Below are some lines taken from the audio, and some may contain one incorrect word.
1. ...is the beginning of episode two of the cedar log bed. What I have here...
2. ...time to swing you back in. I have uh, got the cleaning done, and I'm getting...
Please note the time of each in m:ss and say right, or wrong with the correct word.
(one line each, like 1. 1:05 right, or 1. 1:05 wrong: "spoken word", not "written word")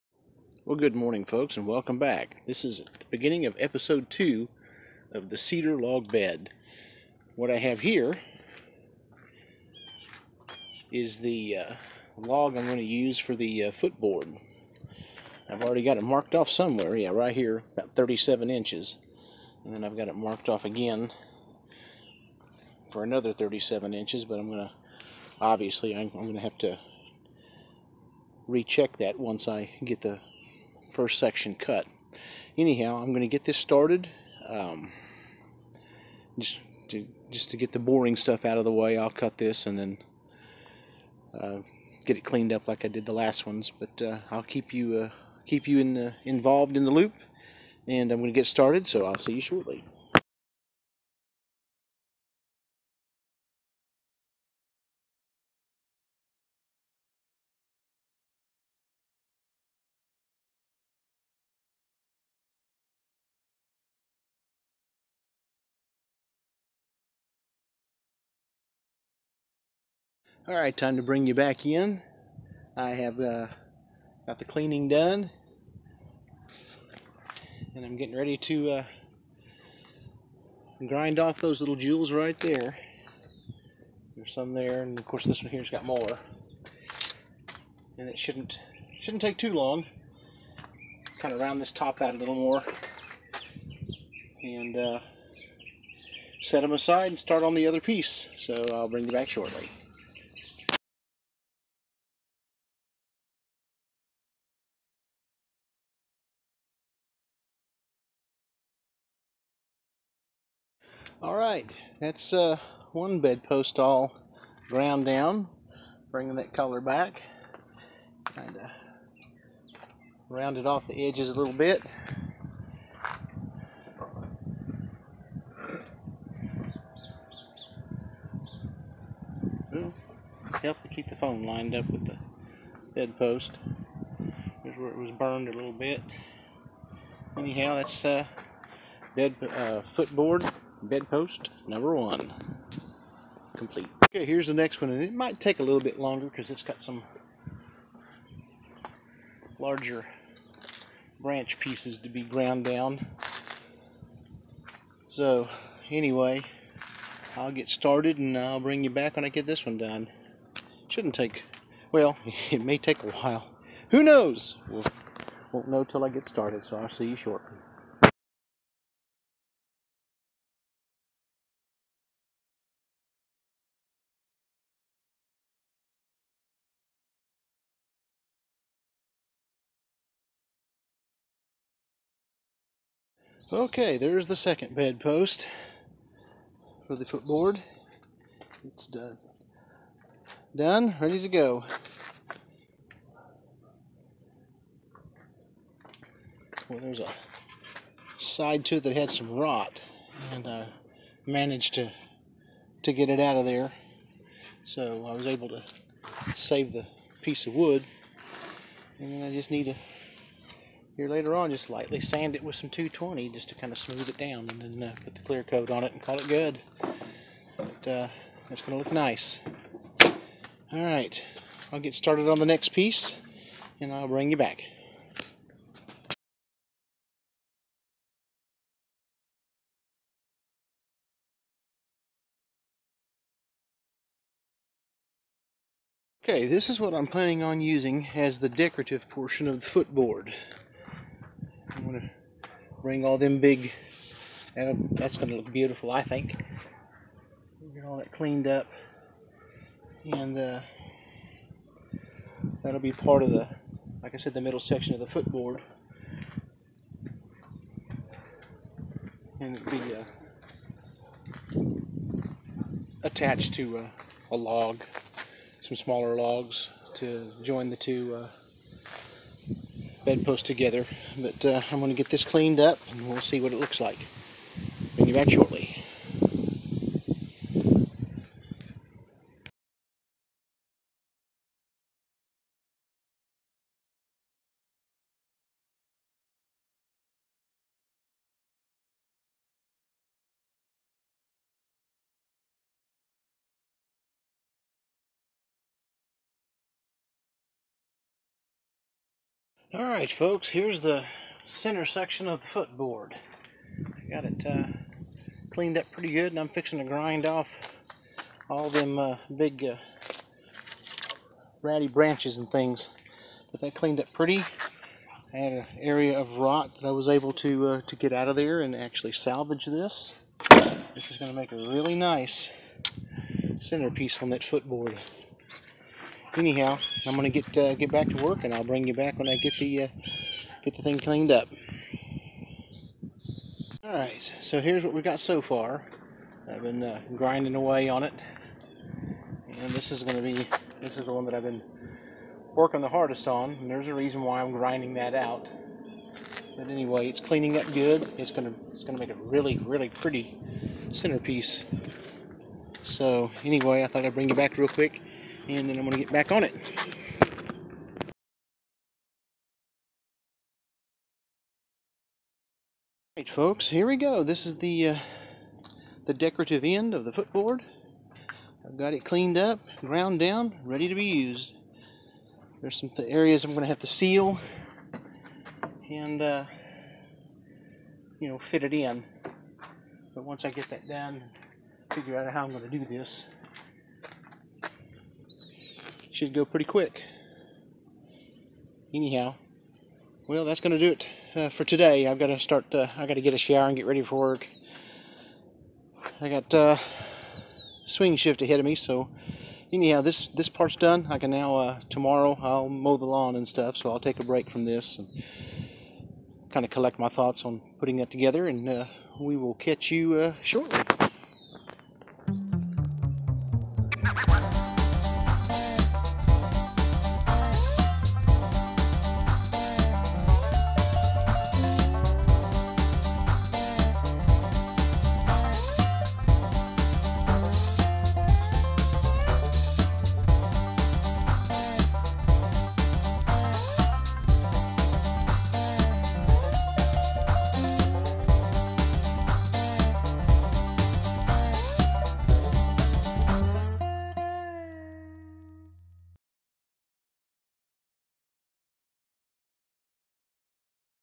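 1. 0:02 right
2. 1:10 wrong: "bring", not "swing".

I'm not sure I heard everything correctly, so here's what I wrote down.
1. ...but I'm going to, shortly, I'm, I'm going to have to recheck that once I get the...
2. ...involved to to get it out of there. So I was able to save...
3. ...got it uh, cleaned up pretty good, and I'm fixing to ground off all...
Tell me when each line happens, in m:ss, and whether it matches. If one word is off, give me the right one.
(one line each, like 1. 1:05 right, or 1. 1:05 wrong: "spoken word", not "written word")
1. 0:24 wrong: "obviously", not "shortly"
2. 3:21 wrong: "managed", not "involved"
3. 5:04 wrong: "grind", not "ground".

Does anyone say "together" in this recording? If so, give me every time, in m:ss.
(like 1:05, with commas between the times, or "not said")
4:30, 6:48.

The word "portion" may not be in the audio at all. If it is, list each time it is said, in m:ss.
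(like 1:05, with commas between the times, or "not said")
3:59.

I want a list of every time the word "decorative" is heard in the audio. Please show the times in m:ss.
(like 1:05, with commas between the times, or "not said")
3:58, 6:06.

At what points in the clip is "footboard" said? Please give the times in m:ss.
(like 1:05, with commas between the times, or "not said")
0:13, 2:19, 3:07, 3:59, 4:15, 5:02, 5:24, 6:07.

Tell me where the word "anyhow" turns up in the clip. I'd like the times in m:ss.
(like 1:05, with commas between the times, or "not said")
0:32, 2:17, 5:26, 6:28, 6:39.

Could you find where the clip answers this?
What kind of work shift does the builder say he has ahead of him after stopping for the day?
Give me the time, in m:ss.
6:37.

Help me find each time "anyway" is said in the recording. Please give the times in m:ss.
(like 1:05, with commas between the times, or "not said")
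2:35, 5:46, 5:53.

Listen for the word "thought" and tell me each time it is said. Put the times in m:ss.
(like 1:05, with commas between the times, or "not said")
5:53, 6:47.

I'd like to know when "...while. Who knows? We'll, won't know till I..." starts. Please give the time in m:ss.
2:43.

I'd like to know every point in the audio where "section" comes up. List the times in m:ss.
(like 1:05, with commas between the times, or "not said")
0:31, 4:14, 5:01.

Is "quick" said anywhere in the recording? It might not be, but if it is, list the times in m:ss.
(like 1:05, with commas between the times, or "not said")
5:54, 6:26.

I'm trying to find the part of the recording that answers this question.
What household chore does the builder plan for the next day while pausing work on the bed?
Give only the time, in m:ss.
6:42.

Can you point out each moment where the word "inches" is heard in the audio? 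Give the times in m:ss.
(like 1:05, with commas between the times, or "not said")
0:18, 0:23.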